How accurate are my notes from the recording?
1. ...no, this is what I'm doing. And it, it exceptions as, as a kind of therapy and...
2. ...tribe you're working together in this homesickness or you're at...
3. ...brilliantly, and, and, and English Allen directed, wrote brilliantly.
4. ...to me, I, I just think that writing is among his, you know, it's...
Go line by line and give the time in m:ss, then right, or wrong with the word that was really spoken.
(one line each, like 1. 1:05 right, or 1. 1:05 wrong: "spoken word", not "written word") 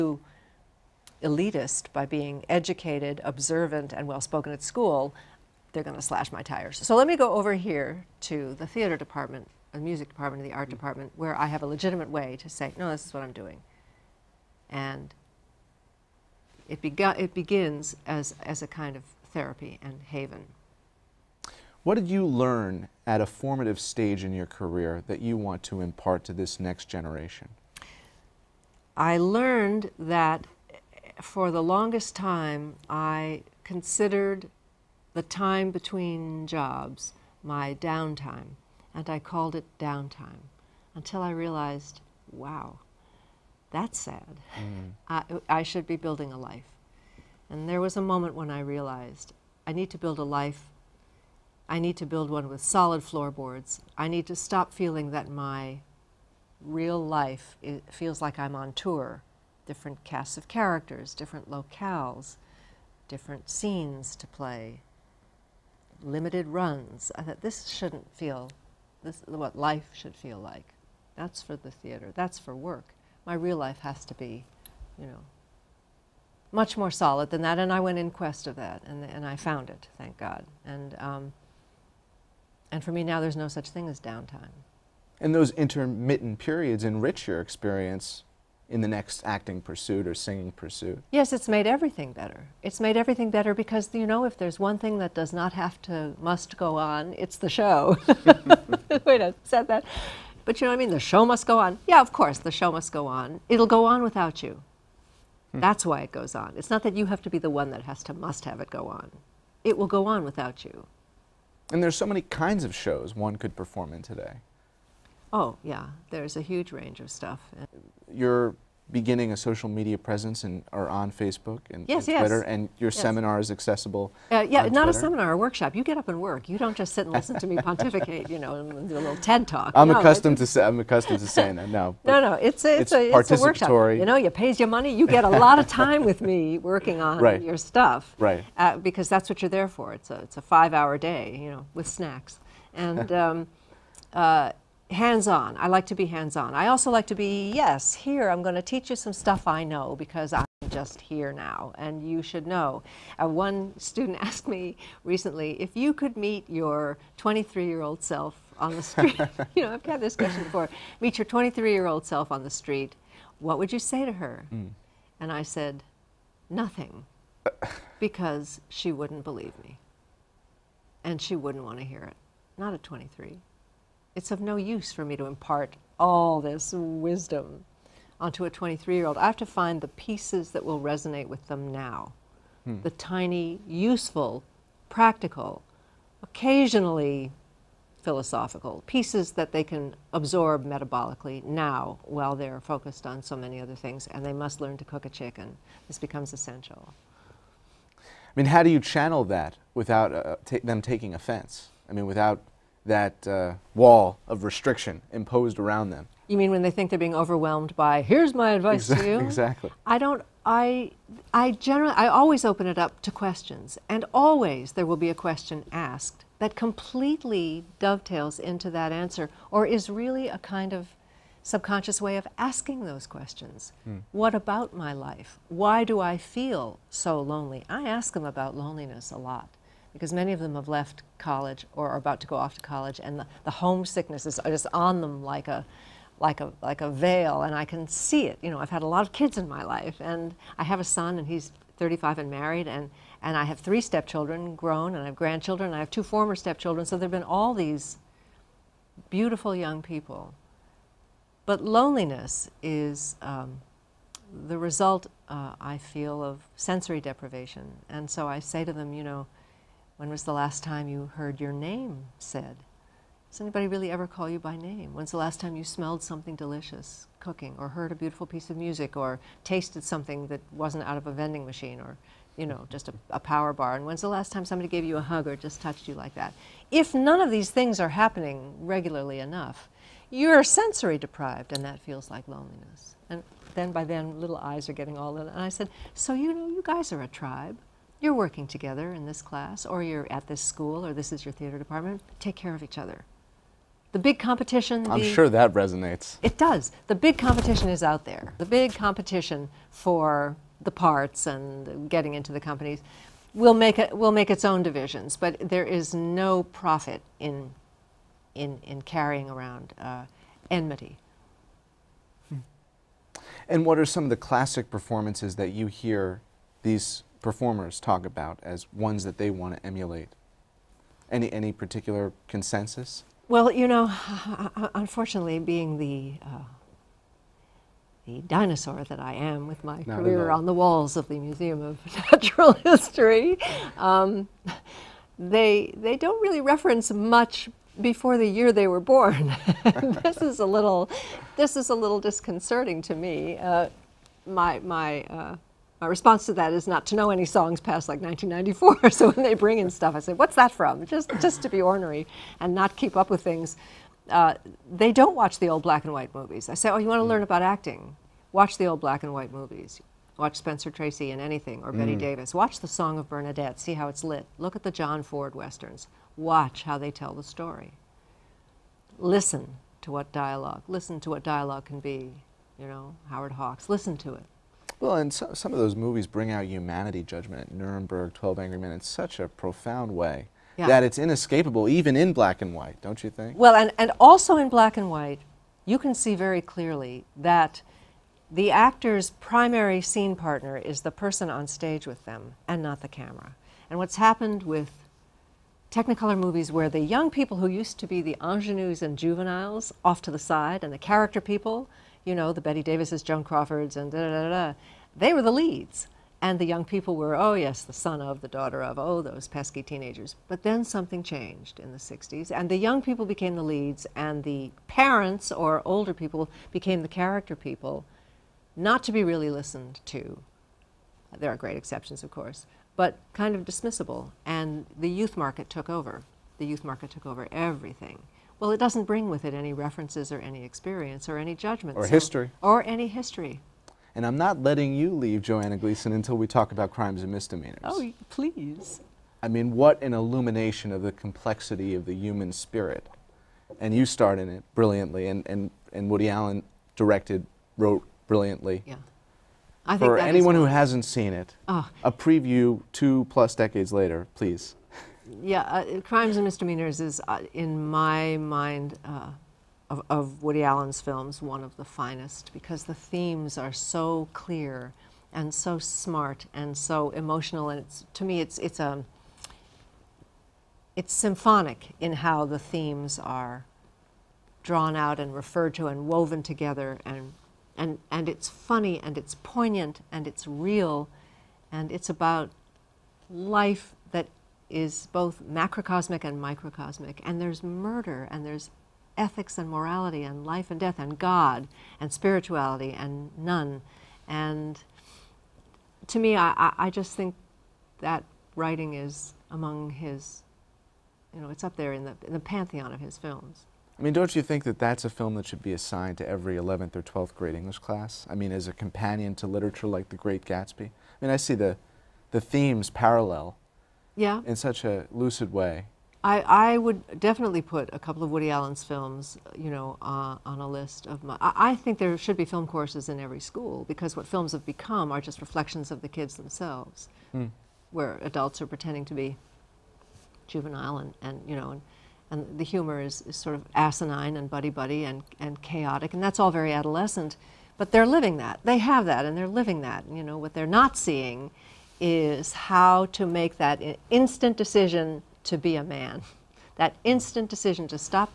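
1. 0:12 wrong: "begins", not "exceptions"
2. 4:47 wrong: "class", not "homesickness"
3. 7:24 wrong: "Woody", not "English"
4. 8:15 right.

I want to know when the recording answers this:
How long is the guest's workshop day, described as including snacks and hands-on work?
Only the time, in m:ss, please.
2:20.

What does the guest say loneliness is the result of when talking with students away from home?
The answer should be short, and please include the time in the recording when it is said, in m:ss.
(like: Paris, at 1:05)
sensory deprivation, at 4:16.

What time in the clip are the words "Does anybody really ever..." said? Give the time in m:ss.
4:23.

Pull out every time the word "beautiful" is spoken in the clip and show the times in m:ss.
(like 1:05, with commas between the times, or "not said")
4:09, 4:27.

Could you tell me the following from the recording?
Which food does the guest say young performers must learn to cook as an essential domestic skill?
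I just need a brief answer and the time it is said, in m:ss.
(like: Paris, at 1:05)
chicken, at 3:14.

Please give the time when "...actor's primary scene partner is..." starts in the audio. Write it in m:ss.
6:28.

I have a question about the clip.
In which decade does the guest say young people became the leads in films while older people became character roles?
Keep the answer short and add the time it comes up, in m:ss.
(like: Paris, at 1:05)
the 60s, at 6:51.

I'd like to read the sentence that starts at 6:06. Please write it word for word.
Watch how they tell the story.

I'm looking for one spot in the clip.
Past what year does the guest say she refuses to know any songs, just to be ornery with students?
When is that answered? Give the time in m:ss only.
5:48.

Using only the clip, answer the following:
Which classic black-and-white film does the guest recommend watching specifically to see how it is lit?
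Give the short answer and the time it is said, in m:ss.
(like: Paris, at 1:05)
The Song of Bernadette, at 6:02.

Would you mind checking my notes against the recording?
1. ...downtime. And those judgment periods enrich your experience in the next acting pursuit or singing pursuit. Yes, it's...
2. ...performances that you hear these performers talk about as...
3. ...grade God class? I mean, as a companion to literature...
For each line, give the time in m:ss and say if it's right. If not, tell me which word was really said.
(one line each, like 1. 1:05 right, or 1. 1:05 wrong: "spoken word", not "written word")
1. 1:23 wrong: "intermittent", not "judgment"
2. 5:14 right
3. 8:27 wrong: "English", not "God".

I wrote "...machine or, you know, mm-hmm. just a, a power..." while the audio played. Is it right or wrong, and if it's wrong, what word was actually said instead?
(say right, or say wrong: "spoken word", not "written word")
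right.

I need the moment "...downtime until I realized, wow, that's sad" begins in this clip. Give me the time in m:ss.
0:39.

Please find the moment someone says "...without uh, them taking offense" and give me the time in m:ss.
3:19.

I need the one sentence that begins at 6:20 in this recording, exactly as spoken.
that it's inescapable even in black and white, don't you think?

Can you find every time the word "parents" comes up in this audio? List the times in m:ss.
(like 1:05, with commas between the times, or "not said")
6:54.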